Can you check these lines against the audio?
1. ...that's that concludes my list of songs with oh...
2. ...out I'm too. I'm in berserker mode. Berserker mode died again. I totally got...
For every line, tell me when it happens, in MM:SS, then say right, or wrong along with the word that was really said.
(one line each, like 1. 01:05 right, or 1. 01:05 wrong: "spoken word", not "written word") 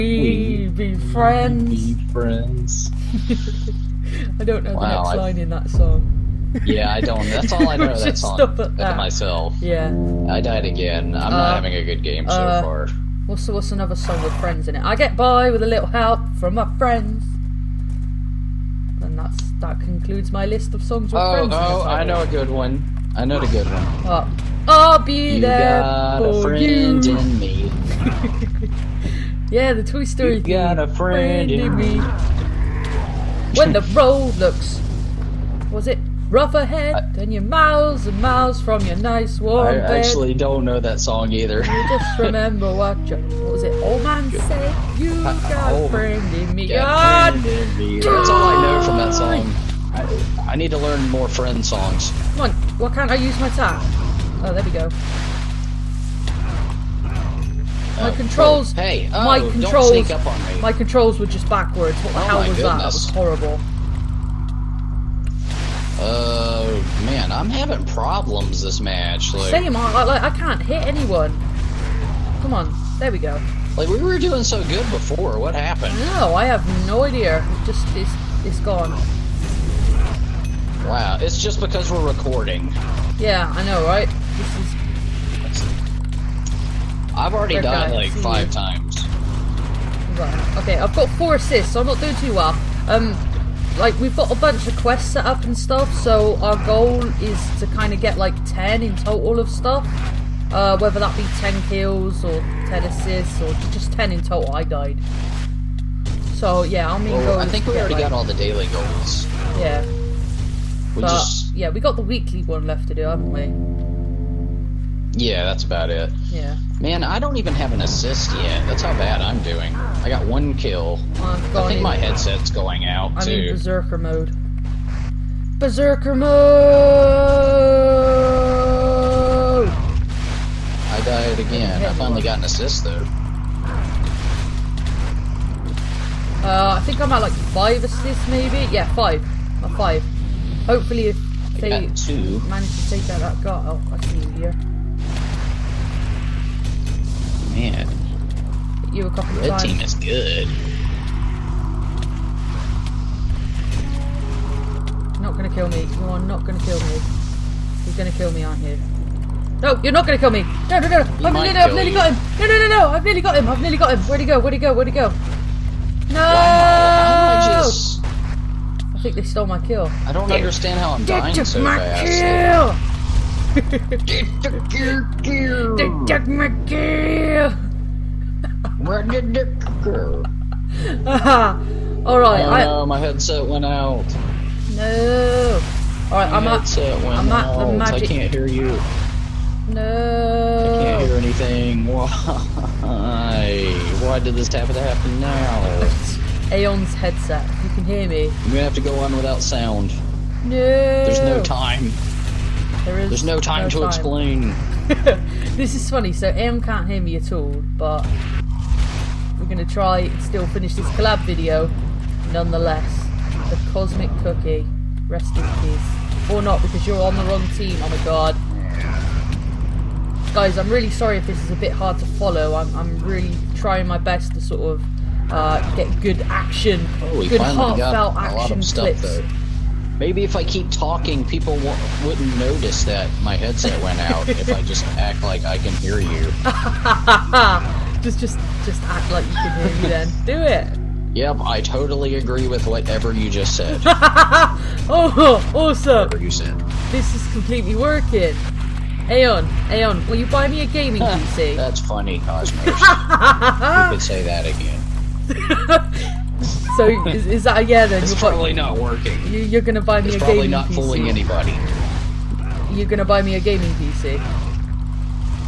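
1. 00:19 right
2. 02:02 wrong: "finally", not "totally".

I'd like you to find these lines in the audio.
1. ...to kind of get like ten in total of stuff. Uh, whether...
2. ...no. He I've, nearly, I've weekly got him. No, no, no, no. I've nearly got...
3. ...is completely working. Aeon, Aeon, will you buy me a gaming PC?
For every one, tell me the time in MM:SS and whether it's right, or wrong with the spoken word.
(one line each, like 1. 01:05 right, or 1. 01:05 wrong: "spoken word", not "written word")
1. 01:37 right
2. 02:40 wrong: "nearly", not "weekly"
3. 04:07 right.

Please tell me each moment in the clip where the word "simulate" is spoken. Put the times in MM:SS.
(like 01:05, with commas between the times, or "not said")
not said.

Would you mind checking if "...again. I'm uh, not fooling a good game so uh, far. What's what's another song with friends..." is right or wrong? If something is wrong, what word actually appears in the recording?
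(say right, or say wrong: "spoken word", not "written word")
wrong: "having", not "fooling".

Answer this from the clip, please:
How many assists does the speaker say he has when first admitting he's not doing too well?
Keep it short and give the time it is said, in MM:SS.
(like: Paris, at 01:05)
4, at 01:31.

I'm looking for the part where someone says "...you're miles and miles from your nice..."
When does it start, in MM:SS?
00:37.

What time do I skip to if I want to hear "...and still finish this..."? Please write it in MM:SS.
03:29.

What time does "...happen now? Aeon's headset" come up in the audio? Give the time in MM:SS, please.
03:14.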